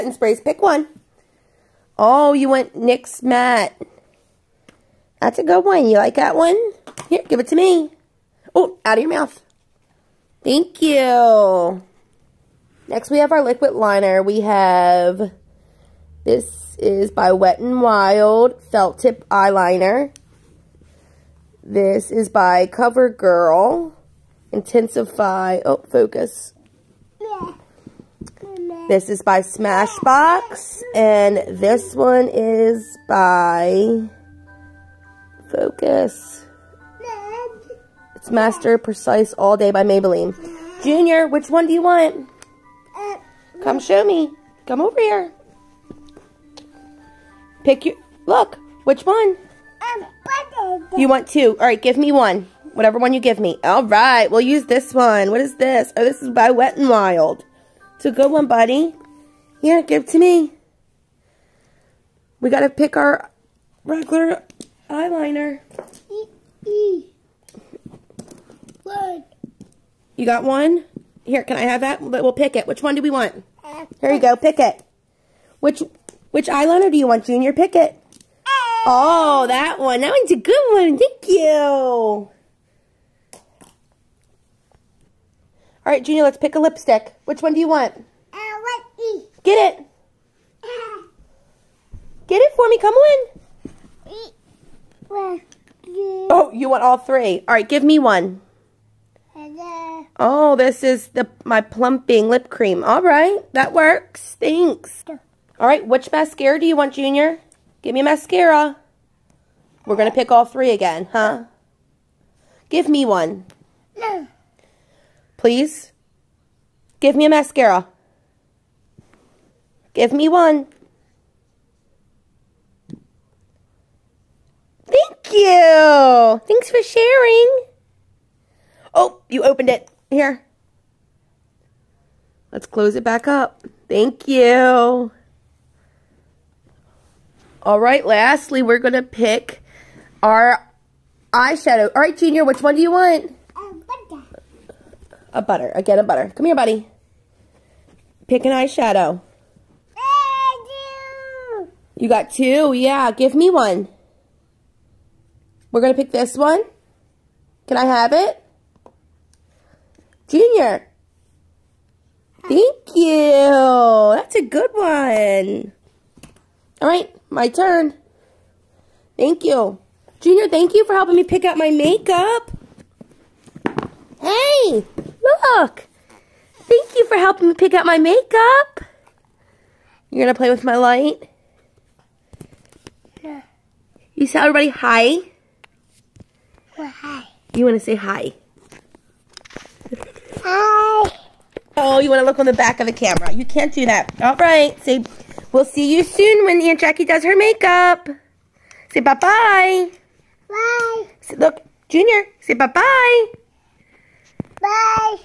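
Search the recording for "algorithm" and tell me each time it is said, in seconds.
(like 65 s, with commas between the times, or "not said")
not said.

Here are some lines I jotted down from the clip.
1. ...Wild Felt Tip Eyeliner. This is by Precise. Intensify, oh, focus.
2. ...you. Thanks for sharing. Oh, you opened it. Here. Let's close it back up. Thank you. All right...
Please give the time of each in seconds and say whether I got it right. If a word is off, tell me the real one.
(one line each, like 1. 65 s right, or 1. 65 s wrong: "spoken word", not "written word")
1. 17 s wrong: "CoverGirl", not "Precise"
2. 125 s right.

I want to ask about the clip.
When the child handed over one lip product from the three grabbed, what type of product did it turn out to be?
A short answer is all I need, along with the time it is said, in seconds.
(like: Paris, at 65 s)
plumping lip cream, at 101 s.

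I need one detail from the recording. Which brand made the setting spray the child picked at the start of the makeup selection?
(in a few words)
NYX.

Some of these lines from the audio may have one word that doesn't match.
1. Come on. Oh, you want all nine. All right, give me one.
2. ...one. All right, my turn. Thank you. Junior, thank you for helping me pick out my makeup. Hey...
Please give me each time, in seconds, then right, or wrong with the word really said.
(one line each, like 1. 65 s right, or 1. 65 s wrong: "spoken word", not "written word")
1. 92 s wrong: "three", not "nine"
2. 164 s right.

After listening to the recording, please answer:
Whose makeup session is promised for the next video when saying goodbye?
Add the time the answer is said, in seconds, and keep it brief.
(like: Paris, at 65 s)
Aunt Jackie, at 196 s.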